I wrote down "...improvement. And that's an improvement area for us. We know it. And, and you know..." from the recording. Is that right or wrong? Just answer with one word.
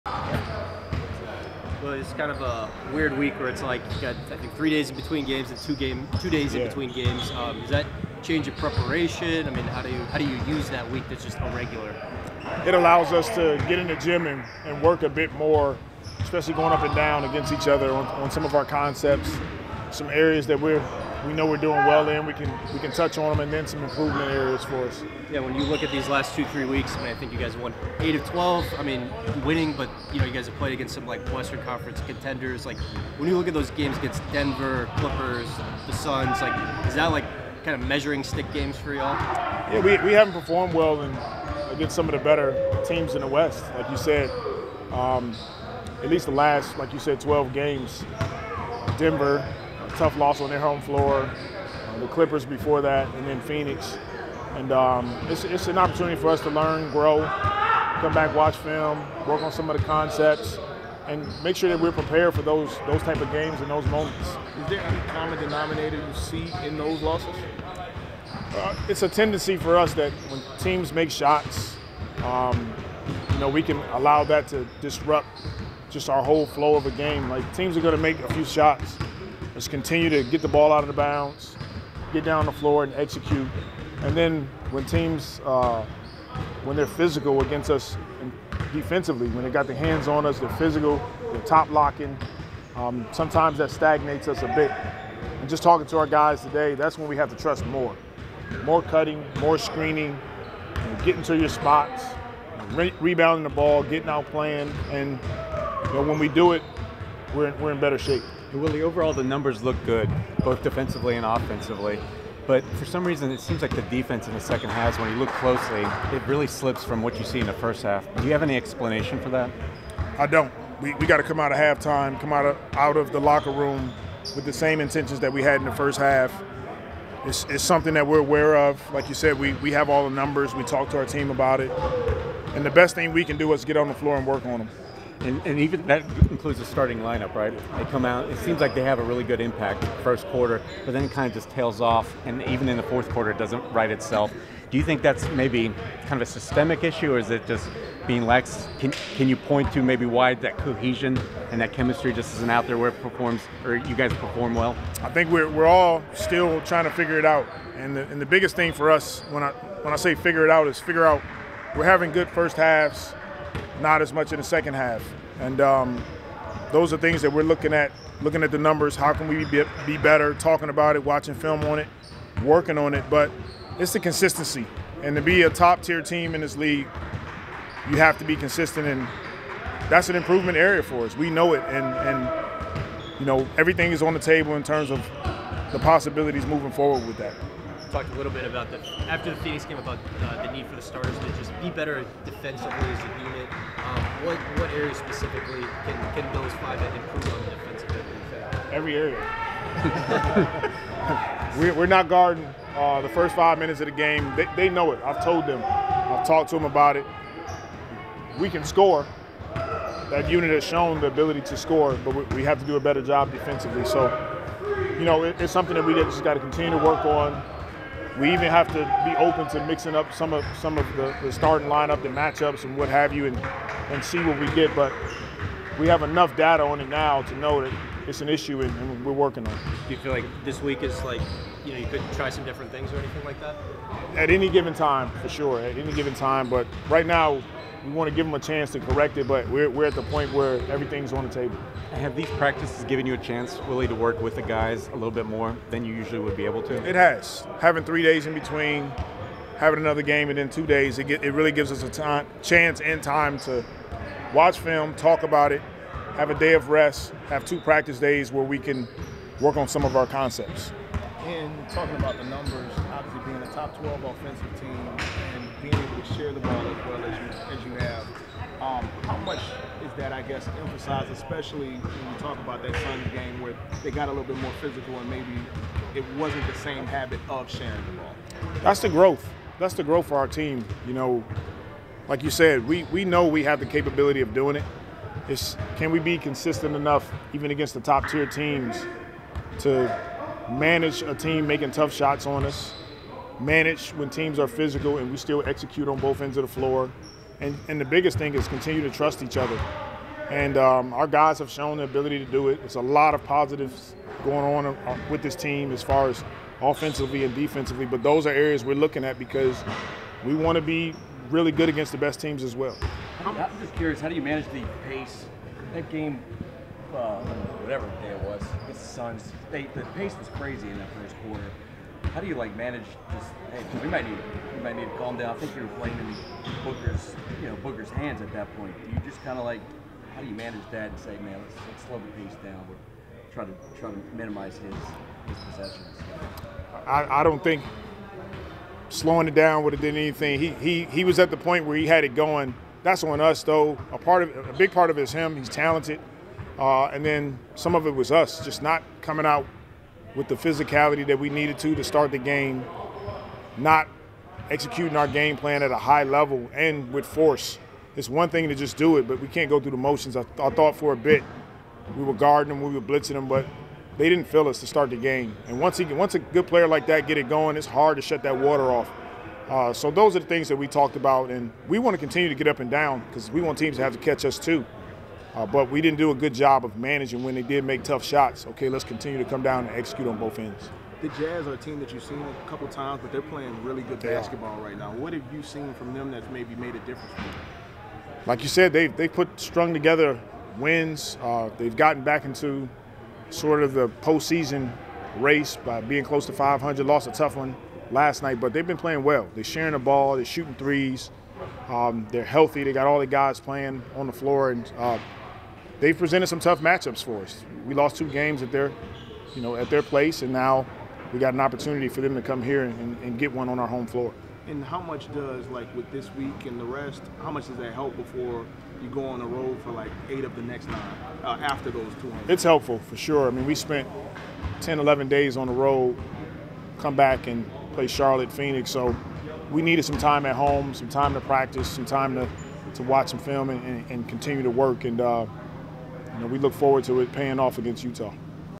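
wrong.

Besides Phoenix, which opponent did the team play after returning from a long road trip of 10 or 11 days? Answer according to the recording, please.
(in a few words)
Charlotte.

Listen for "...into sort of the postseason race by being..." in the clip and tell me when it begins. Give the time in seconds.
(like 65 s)
392 s.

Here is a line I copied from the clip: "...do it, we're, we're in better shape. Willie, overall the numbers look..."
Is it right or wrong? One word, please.
right.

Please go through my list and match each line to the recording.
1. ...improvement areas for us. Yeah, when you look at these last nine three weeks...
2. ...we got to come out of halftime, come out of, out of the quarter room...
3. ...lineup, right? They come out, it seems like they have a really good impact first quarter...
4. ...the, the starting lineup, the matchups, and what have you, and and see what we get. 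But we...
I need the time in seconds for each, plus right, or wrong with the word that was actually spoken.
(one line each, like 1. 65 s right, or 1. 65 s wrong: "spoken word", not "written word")
1. 23 s wrong: "two", not "nine"
2. 120 s wrong: "locker", not "quarter"
3. 136 s right
4. 220 s right.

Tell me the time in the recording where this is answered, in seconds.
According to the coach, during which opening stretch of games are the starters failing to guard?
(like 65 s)
203 s.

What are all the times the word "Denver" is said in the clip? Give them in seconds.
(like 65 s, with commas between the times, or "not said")
34 s, 48 s.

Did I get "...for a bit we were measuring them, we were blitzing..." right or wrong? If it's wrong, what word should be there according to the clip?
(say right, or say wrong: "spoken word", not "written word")
wrong: "guarding", not "measuring".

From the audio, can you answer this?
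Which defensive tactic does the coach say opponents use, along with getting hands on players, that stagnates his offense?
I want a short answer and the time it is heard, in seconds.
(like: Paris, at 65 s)
Top locking, at 91 s.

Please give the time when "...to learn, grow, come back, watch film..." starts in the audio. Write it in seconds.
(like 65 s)
56 s.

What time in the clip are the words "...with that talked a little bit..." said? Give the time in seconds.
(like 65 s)
187 s.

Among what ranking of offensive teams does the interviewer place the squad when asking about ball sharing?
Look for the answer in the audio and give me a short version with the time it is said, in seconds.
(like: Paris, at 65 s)
Top 12, at 263 s.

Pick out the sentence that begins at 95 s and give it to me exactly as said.
And just talking to our guys today, that's when we have to trust more.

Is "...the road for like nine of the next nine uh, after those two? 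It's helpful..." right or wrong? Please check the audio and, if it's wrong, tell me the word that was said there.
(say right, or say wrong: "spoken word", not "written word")
wrong: "eight", not "nine".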